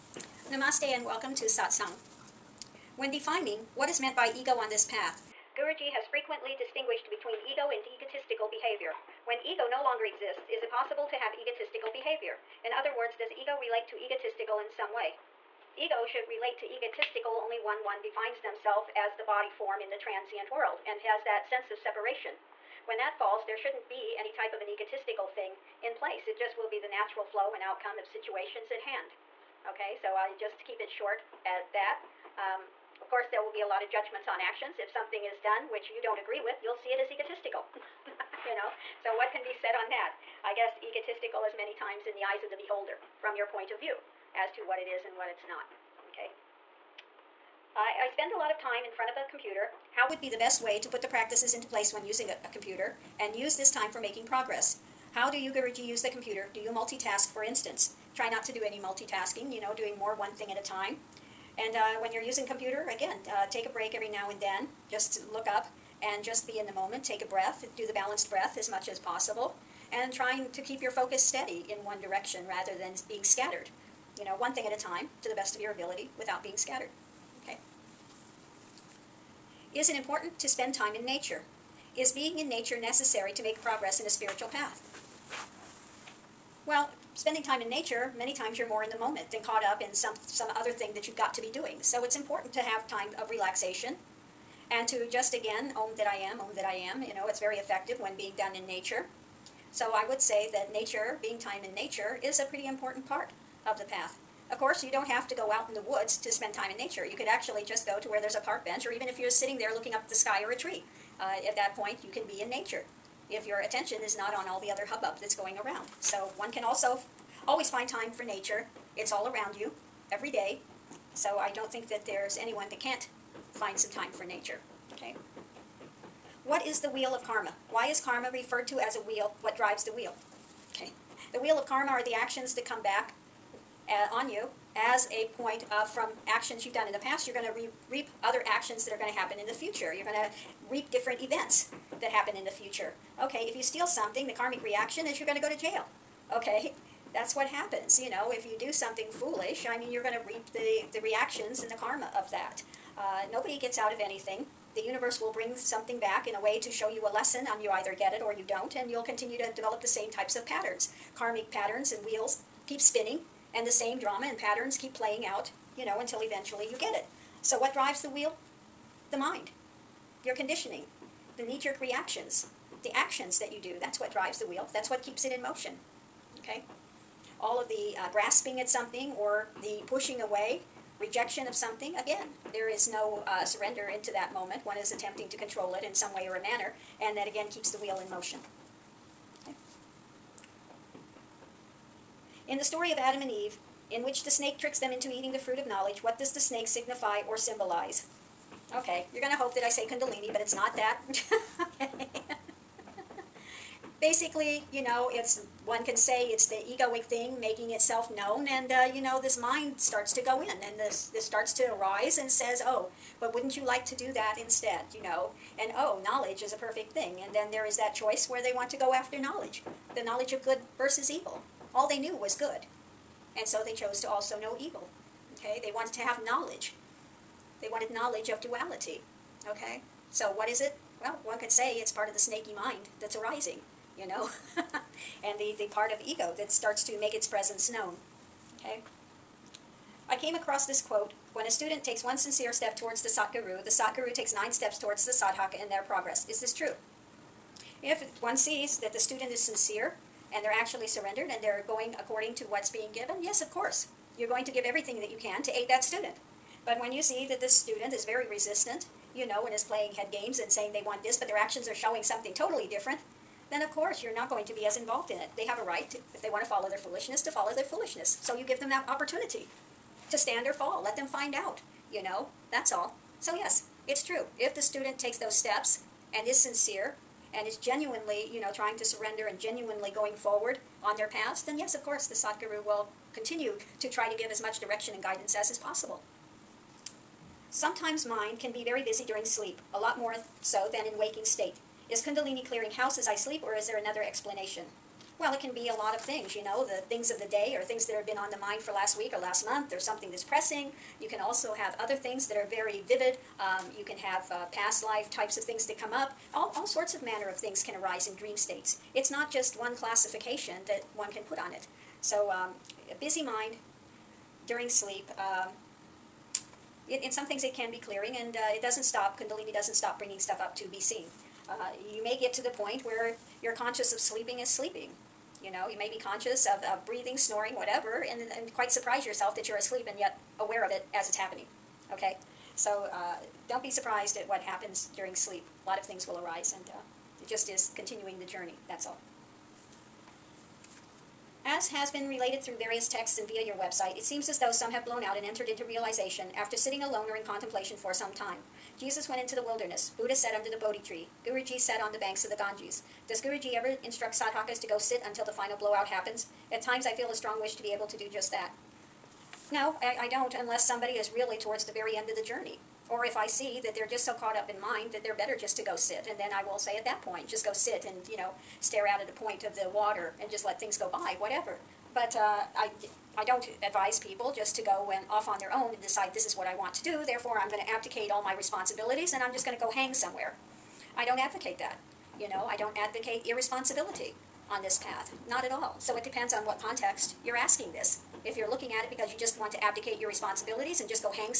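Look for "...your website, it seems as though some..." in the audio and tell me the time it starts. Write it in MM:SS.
05:43.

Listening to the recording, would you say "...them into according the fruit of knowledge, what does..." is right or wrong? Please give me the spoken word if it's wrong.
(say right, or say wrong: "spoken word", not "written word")
wrong: "eating", not "according".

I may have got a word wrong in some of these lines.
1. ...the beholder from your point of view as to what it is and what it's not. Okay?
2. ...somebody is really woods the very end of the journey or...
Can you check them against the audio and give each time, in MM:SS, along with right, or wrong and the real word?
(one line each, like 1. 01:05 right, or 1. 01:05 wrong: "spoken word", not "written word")
1. 00:42 right
2. 06:00 wrong: "towards", not "woods".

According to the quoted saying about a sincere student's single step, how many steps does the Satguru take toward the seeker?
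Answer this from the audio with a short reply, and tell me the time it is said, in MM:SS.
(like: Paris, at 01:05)
9, at 04:04.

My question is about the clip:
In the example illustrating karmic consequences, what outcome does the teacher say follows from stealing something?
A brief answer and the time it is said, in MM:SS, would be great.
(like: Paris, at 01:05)
go to jail, at 02:25.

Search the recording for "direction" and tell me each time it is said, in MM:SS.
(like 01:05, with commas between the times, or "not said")
01:12, 04:44.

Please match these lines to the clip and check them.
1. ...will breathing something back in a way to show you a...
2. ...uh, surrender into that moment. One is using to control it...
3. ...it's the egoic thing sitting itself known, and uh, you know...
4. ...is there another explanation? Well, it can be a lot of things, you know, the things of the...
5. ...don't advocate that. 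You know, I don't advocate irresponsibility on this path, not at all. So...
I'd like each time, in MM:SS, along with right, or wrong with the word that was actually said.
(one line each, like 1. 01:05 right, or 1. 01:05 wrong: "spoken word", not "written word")
1. 02:35 wrong: "bring", not "breathing"
2. 03:03 wrong: "attempting", not "using"
3. 03:26 wrong: "making", not "sitting"
4. 04:53 right
5. 06:21 right.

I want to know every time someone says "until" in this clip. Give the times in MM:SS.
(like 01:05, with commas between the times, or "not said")
02:45, 05:55.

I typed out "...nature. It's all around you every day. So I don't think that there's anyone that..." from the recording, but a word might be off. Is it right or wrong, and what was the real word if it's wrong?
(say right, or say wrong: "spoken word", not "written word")
right.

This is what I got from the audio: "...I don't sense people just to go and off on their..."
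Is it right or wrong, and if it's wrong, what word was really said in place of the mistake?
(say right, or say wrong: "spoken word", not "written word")
wrong: "advise", not "sense".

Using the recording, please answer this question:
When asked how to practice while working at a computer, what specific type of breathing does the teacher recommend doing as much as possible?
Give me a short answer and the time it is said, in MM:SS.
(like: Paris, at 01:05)
balanced breath, at 01:07.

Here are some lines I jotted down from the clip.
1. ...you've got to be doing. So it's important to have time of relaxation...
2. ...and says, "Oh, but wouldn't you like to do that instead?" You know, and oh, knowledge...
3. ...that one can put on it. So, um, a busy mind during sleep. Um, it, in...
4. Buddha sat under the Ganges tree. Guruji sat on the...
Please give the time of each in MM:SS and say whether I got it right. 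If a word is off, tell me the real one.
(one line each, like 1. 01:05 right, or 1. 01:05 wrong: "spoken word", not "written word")
1. 01:31 right
2. 03:32 right
3. 05:10 right
4. 05:49 wrong: "Bodhi", not "Ganges".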